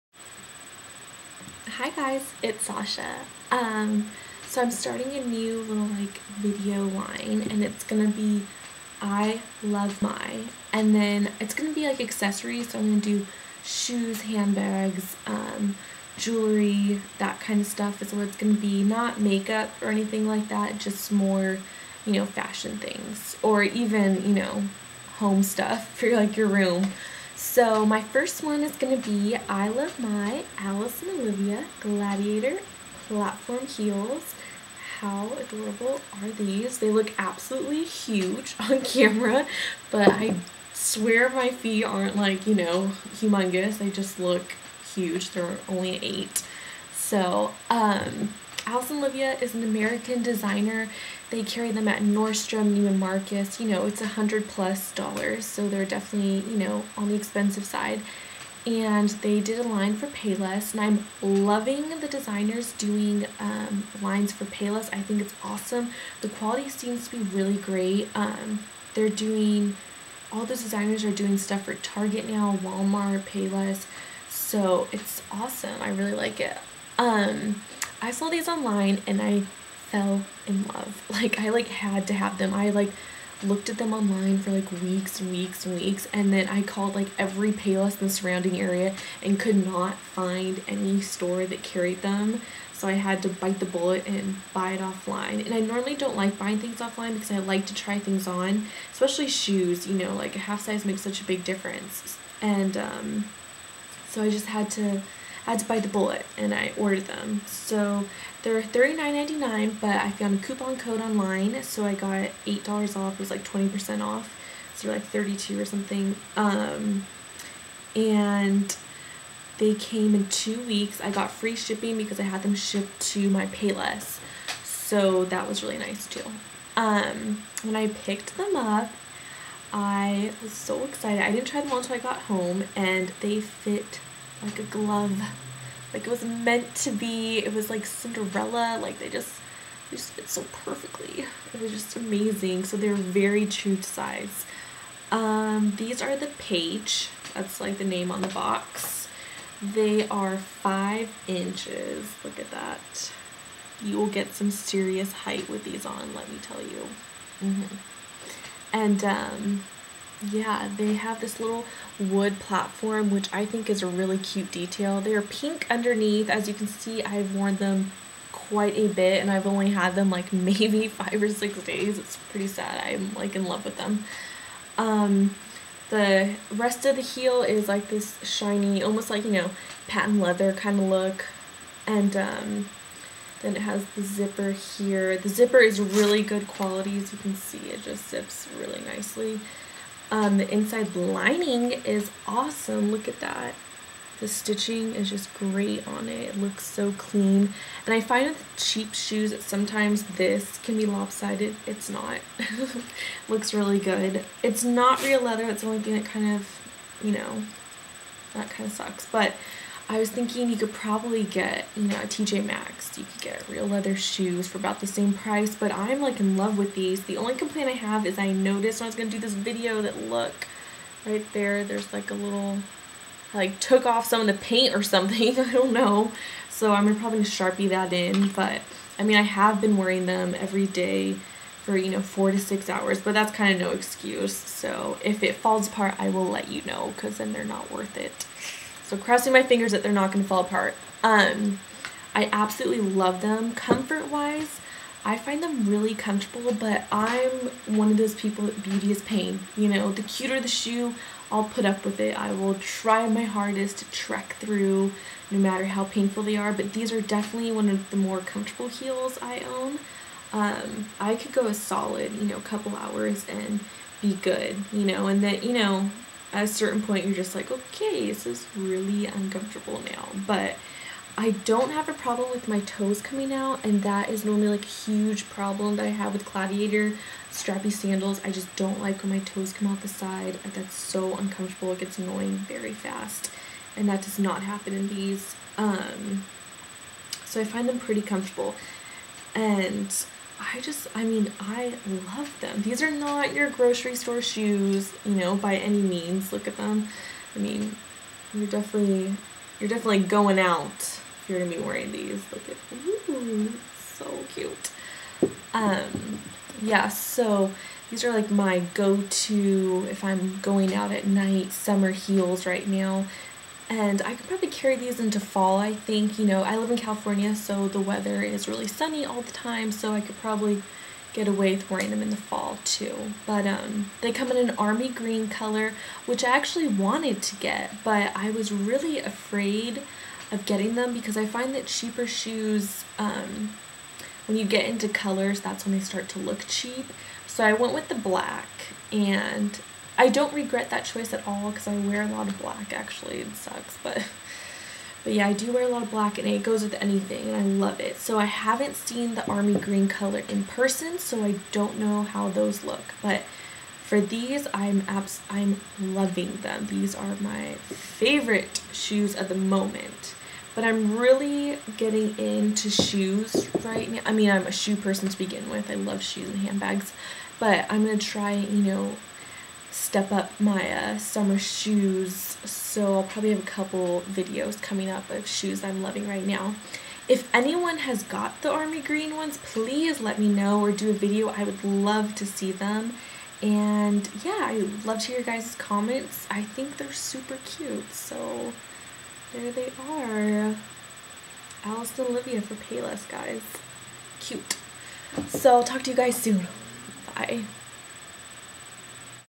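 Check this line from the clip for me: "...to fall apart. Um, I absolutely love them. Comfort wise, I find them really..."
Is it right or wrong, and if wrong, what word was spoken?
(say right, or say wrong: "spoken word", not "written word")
right.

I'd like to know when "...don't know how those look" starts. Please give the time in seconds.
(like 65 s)
351 s.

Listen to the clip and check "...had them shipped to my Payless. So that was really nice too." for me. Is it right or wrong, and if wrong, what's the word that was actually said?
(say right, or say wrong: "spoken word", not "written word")
right.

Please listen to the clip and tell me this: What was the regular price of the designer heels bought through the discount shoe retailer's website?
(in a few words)
$39.99.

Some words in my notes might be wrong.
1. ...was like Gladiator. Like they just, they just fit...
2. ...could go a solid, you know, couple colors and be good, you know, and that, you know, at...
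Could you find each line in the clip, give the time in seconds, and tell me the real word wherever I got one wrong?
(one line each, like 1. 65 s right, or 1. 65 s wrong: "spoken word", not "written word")
1. 137 s wrong: "Cinderella", not "Gladiator"
2. 261 s wrong: "hours", not "colors".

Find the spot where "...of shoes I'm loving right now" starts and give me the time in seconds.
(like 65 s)
375 s.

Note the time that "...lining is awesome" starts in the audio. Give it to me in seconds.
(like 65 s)
190 s.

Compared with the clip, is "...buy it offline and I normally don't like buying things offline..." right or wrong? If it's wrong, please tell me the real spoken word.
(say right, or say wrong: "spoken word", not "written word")
right.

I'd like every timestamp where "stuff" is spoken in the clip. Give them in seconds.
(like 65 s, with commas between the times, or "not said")
17 s, 25 s, 71 s.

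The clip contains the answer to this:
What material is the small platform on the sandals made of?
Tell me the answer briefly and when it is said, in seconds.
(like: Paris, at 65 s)
Wood, at 161 s.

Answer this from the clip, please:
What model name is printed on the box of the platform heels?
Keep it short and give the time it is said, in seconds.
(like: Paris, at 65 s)
Paige, at 146 s.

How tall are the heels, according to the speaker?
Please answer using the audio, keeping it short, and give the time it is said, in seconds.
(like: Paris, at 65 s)
5 inches, at 150 s.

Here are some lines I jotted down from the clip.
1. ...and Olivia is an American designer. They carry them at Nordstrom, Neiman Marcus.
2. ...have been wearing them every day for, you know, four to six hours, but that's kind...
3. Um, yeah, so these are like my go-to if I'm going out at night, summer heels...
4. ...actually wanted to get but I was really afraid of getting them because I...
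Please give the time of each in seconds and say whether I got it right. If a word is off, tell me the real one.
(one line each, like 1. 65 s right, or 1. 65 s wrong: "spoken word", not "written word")
1. 48 s right
2. 229 s right
3. 305 s right
4. 326 s right.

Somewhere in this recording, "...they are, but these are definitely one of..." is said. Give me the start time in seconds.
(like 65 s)
256 s.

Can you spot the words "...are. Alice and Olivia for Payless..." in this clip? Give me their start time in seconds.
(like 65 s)
389 s.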